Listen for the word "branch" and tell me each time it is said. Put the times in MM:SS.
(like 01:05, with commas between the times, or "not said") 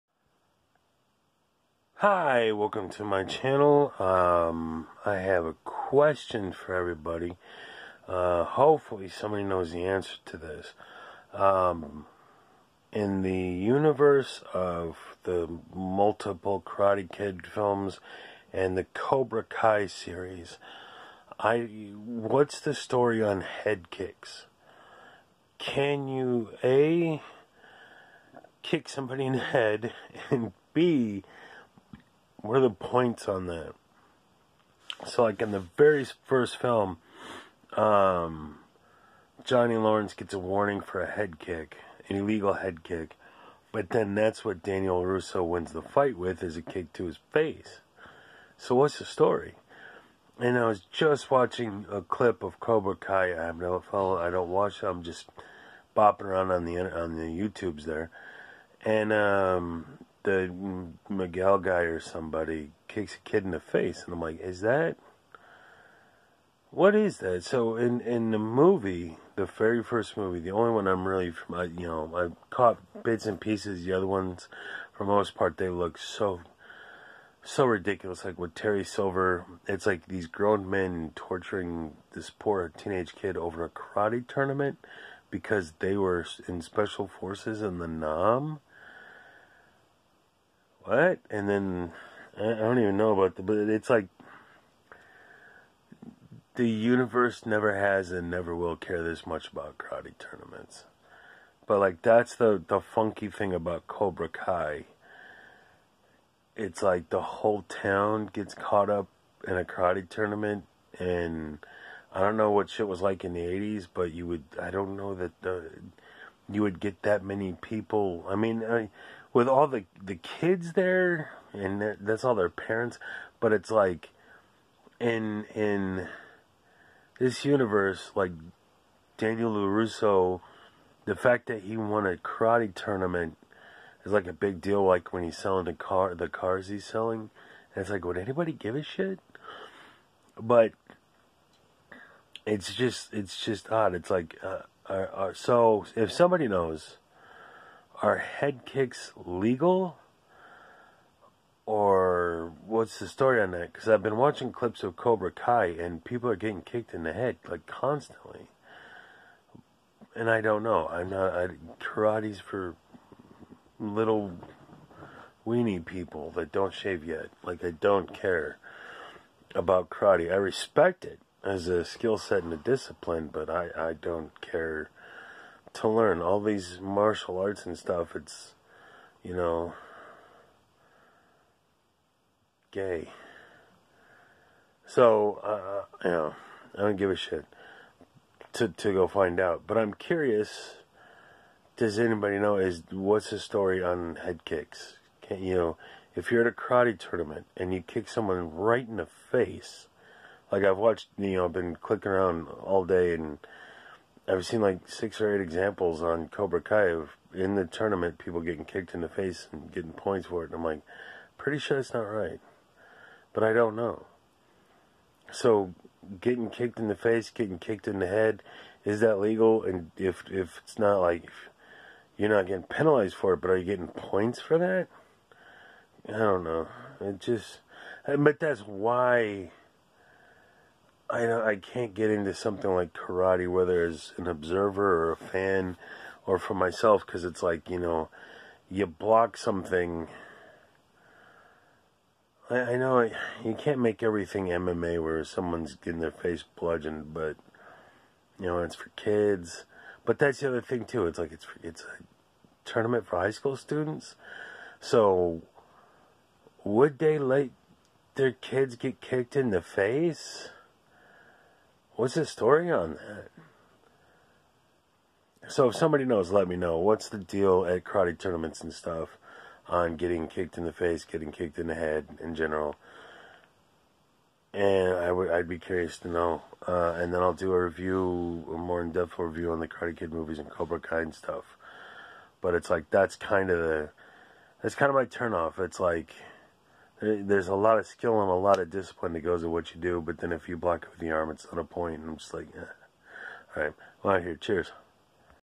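not said.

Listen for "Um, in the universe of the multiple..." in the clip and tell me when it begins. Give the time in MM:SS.
00:11.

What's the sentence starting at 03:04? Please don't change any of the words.
So, uh, you know, I don't give a shit to, to go find out.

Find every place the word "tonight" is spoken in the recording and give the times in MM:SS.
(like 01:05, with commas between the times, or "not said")
not said.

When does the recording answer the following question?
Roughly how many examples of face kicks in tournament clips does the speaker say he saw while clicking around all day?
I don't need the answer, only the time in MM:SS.
03:24.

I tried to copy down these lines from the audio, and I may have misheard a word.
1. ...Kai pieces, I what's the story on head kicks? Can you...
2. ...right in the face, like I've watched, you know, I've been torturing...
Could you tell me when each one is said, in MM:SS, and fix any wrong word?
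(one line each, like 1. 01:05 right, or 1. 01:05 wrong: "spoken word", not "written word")
1. 00:19 wrong: "series", not "pieces"
2. 03:18 wrong: "clicking", not "torturing".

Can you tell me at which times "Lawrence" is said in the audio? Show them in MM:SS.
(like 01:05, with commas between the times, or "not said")
00:39.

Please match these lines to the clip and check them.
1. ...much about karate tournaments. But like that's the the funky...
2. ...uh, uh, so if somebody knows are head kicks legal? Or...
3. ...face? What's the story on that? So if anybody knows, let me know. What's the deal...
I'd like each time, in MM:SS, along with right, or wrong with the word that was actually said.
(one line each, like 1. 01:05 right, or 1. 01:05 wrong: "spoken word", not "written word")
1. 01:39 right
2. 02:24 right
3. 04:19 wrong: "somebody", not "anybody".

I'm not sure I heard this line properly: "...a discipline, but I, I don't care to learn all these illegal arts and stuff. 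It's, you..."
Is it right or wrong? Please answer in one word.
wrong.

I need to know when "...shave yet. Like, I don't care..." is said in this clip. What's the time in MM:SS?
02:46.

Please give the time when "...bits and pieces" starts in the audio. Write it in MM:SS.
01:13.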